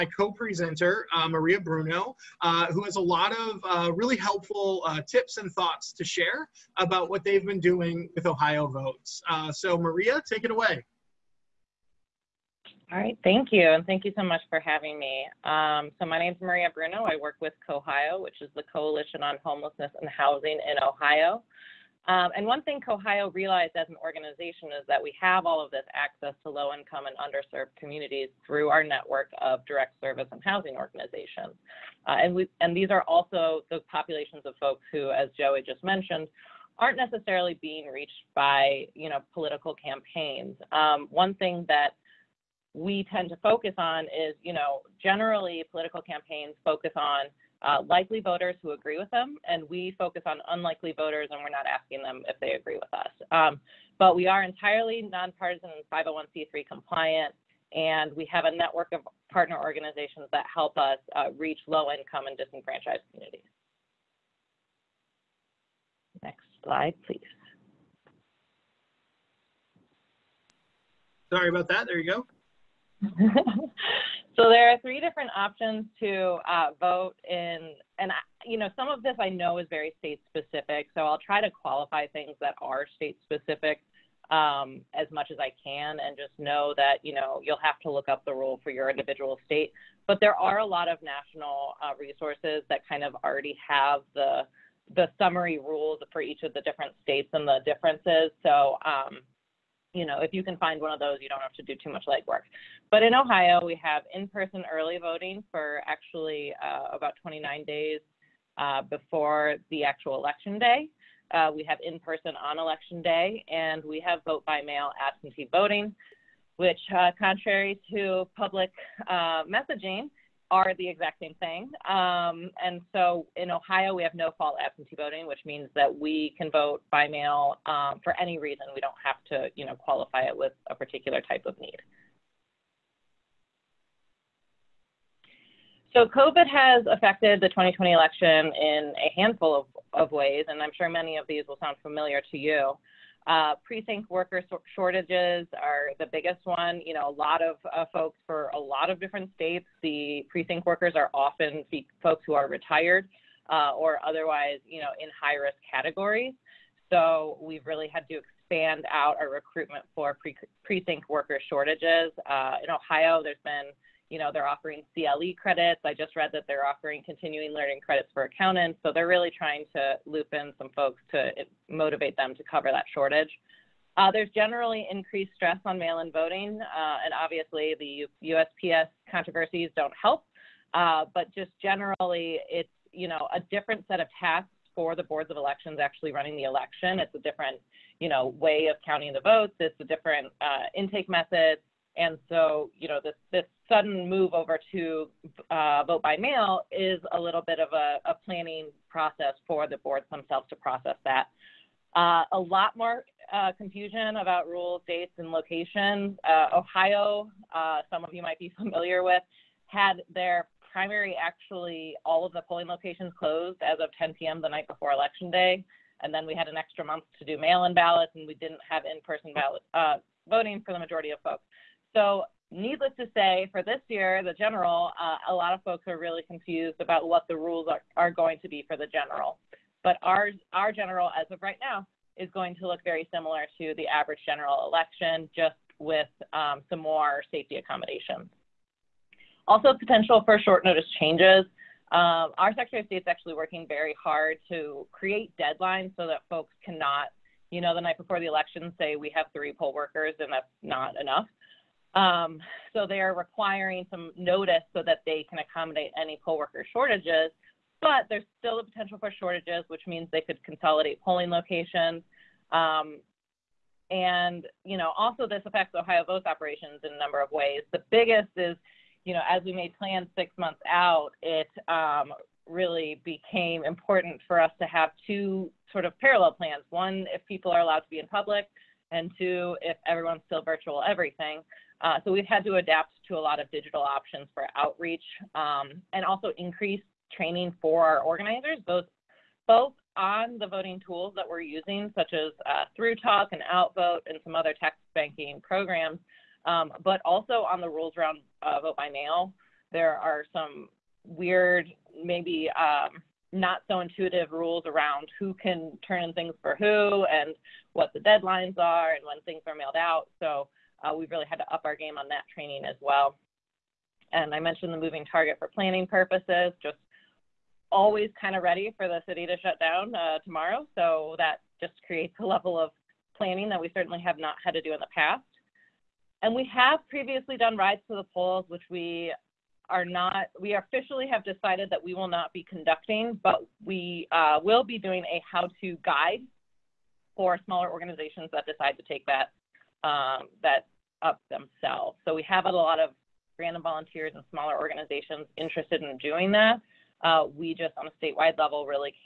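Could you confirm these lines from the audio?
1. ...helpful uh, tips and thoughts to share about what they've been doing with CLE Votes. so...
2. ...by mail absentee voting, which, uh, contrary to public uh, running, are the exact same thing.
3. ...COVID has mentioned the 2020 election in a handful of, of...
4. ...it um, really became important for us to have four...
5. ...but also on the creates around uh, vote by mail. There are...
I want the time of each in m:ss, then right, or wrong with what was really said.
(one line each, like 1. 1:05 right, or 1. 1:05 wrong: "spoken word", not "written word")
1. 0:04 wrong: "Ohio", not "CLE"
2. 1:54 wrong: "messaging", not "running"
3. 2:16 wrong: "affected", not "mentioned"
4. 4:31 wrong: "two", not "four"
5. 4:56 wrong: "rules", not "creates".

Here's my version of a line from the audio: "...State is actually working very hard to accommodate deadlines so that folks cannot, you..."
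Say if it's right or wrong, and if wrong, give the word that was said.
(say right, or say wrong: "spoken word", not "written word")
wrong: "create", not "accommodate".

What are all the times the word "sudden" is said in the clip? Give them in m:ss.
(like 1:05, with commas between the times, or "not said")
3:13.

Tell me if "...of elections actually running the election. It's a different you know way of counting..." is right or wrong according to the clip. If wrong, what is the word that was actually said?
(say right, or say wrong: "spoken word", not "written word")
right.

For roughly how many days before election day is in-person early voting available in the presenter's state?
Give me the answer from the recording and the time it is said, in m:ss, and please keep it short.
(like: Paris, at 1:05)
29, at 1:47.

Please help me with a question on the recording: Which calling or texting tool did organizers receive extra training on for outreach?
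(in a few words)
ThruTalk.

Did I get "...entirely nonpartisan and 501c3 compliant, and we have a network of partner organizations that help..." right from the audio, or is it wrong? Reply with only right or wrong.
right.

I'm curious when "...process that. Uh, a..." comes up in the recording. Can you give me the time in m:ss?
3:20.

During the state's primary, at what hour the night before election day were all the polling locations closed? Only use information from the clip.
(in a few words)
10 p.m.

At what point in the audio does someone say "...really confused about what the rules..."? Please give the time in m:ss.
3:45.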